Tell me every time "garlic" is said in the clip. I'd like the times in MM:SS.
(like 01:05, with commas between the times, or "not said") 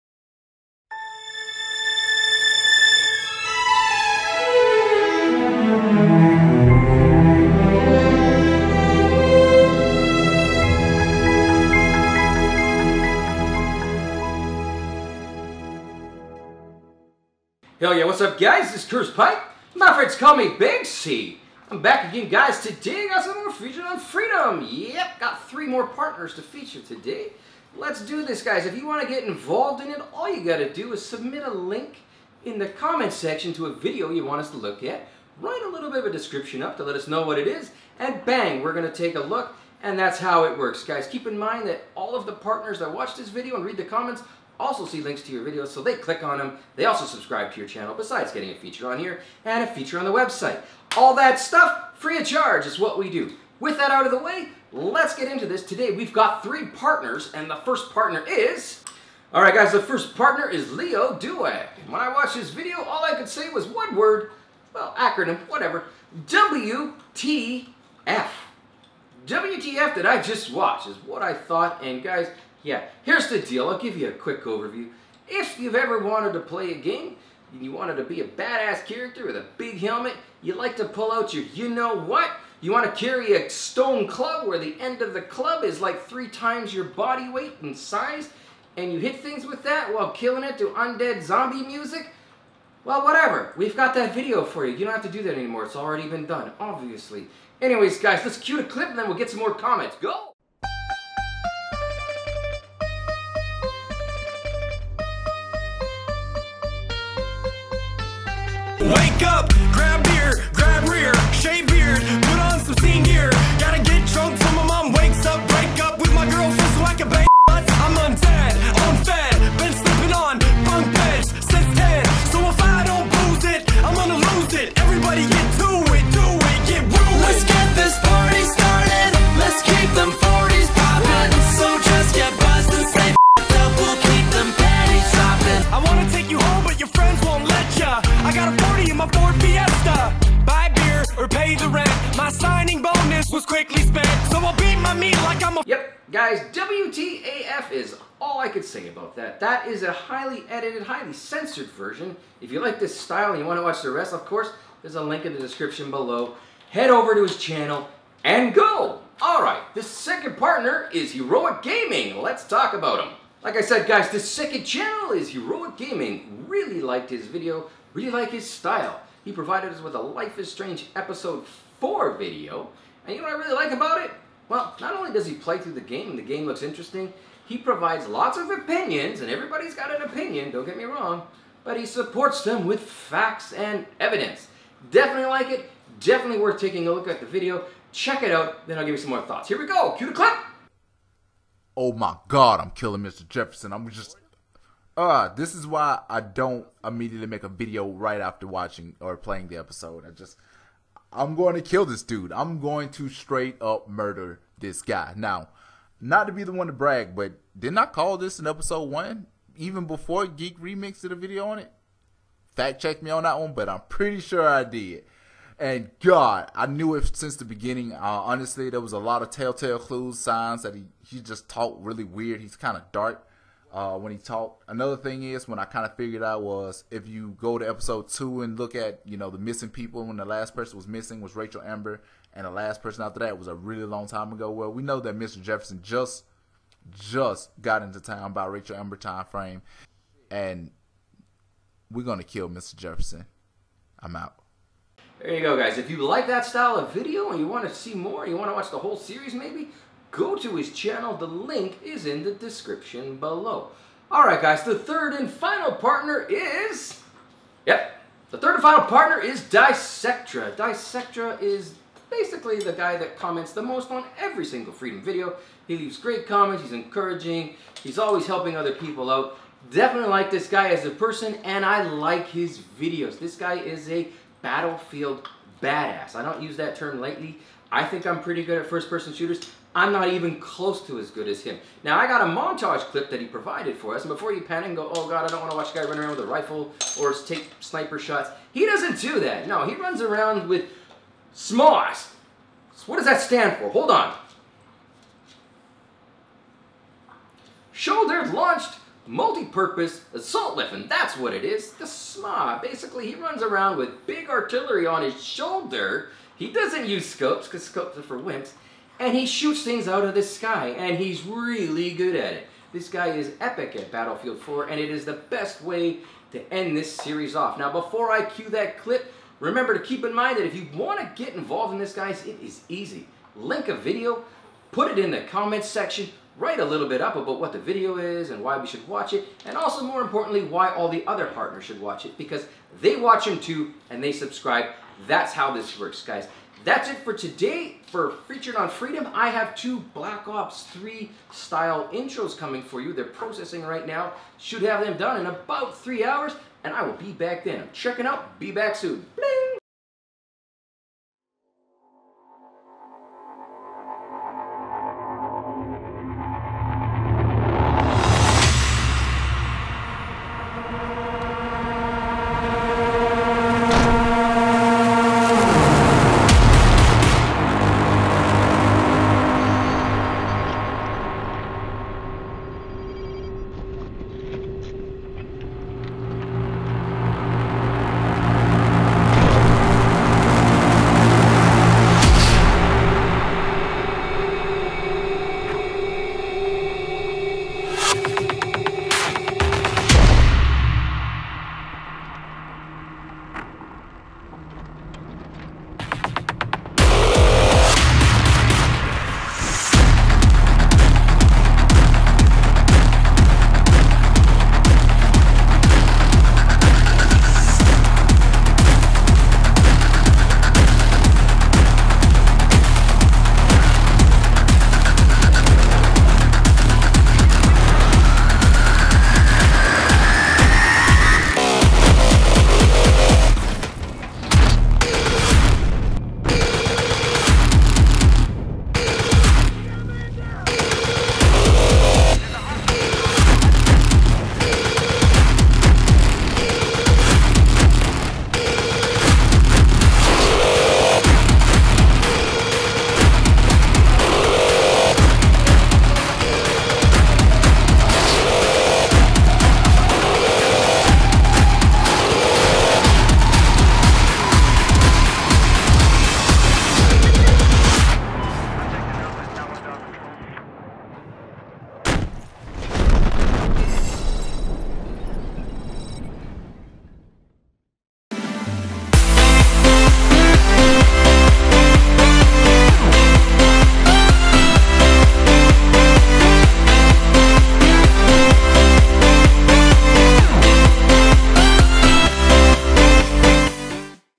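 not said.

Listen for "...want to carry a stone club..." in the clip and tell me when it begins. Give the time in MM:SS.
01:22.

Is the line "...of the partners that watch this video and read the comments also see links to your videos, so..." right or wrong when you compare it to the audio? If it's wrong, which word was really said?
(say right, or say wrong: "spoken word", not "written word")
right.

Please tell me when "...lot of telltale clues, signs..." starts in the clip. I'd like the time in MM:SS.
03:38.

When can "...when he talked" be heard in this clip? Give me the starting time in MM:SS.
03:43.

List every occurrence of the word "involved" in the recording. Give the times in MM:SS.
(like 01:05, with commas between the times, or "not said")
00:29, 05:21.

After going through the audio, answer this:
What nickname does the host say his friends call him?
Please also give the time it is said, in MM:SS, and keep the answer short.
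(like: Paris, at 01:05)
Big C, at 00:20.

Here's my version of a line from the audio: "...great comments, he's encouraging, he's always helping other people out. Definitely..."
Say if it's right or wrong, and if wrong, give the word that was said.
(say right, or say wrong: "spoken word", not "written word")
right.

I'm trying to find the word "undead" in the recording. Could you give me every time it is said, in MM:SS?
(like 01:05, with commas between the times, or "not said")
01:30.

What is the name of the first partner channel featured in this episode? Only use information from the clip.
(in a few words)
LioDuak.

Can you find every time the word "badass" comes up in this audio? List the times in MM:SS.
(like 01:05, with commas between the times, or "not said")
01:18, 04:35.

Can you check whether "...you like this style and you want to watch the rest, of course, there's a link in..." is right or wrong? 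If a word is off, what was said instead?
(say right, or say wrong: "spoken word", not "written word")
right.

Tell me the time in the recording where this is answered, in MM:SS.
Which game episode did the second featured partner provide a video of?
02:50.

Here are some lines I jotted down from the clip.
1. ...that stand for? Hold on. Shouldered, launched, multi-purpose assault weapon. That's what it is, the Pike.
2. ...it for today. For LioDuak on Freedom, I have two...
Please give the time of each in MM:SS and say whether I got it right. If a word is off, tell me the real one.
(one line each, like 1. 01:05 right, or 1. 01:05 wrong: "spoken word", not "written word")
1. 04:53 wrong: "SMAW", not "Pike"
2. 05:36 wrong: "Featured", not "LioDuak".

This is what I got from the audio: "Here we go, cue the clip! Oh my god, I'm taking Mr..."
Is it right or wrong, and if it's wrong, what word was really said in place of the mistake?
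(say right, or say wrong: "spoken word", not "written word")
wrong: "killing", not "taking".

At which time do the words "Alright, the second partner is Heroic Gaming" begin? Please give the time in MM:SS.
02:39.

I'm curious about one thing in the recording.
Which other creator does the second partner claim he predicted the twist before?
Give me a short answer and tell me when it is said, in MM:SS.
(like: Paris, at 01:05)
Geek Remix, at 03:30.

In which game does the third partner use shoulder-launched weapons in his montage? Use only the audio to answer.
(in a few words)
Battlefield 4.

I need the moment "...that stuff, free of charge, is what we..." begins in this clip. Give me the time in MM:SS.
00:51.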